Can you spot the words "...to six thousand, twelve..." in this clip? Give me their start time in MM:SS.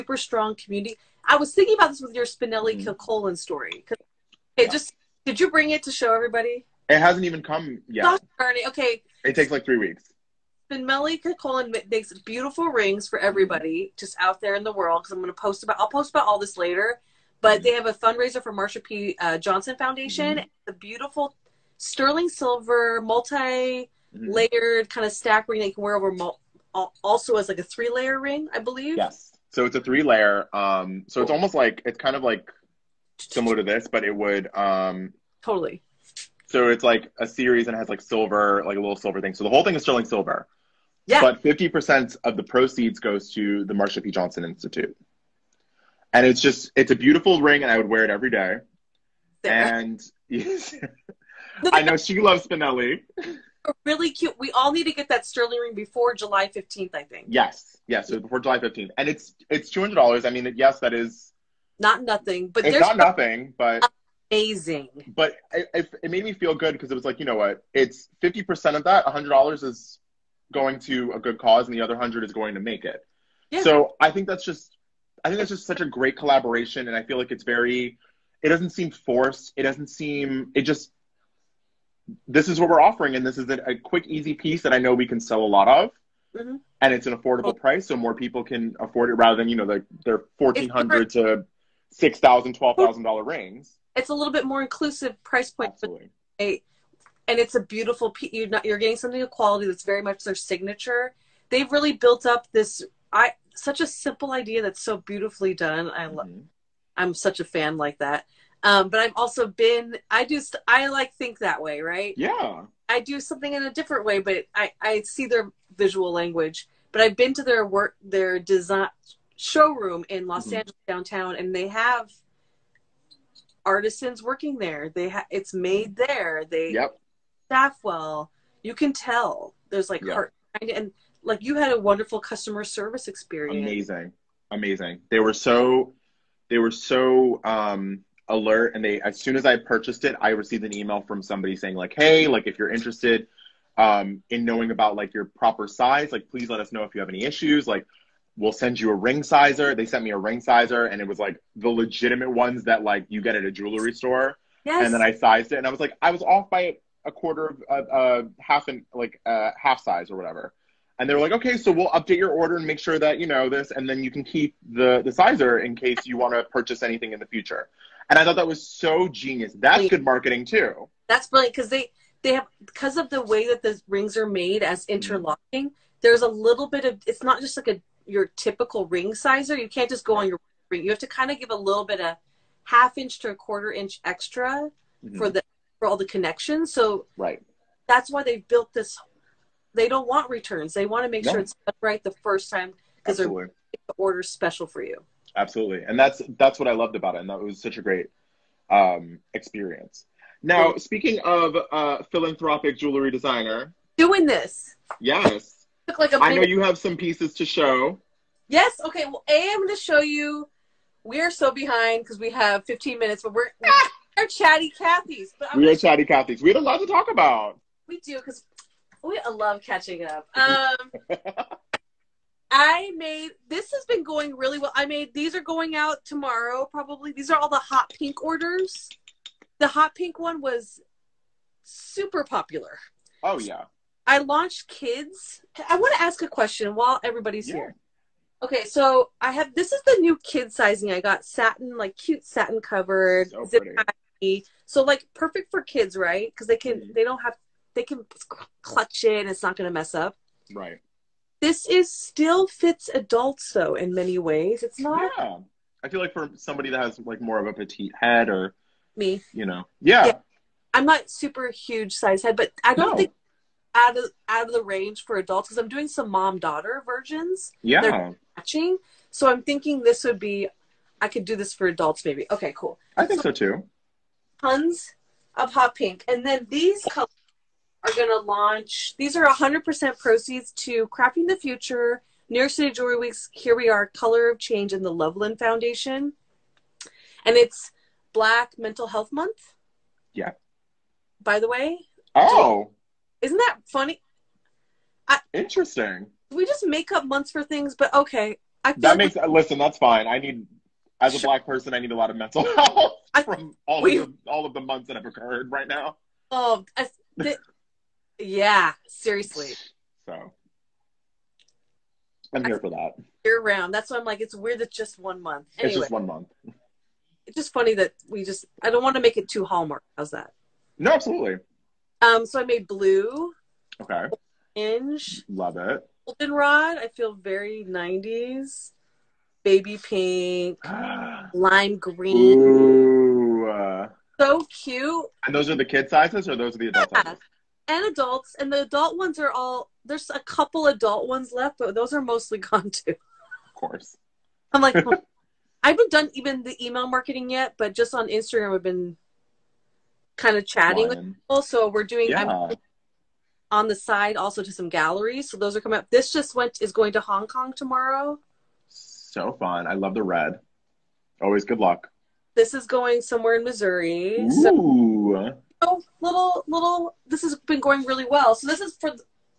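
01:31.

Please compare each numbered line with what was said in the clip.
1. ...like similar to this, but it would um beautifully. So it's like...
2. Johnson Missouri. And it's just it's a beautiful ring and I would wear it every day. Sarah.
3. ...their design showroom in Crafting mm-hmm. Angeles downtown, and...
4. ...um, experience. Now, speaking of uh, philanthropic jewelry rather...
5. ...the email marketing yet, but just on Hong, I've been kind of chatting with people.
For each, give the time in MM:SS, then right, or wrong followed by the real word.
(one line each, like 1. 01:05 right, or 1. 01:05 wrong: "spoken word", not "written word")
1. 00:32 wrong: "totally", not "beautifully"
2. 00:44 wrong: "Institute", not "Missouri"
3. 01:58 wrong: "Los", not "Crafting"
4. 03:18 wrong: "designer", not "rather"
5. 05:46 wrong: "Instagram", not "Hong".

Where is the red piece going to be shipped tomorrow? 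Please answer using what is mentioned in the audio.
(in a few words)
Hong Kong.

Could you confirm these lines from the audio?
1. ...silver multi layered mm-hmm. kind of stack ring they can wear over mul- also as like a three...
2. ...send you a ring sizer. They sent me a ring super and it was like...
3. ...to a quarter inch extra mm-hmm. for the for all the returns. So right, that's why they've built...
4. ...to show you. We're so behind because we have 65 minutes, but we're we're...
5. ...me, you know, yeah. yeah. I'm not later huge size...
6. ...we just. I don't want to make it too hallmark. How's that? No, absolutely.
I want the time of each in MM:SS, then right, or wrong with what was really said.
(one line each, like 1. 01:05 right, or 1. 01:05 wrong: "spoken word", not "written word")
1. 00:22 right
2. 02:28 wrong: "sizer", not "super"
3. 03:03 wrong: "connections", not "returns"
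4. 03:29 wrong: "15", not "65"
5. 04:18 wrong: "super", not "later"
6. 05:18 right.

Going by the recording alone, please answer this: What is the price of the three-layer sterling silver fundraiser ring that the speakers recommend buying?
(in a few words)
$200.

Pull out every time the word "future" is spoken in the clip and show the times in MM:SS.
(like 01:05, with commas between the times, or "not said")
02:47, 04:41.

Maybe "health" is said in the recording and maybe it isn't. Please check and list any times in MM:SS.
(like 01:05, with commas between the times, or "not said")
04:48, 05:02.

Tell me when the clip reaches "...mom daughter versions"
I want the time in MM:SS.
04:26.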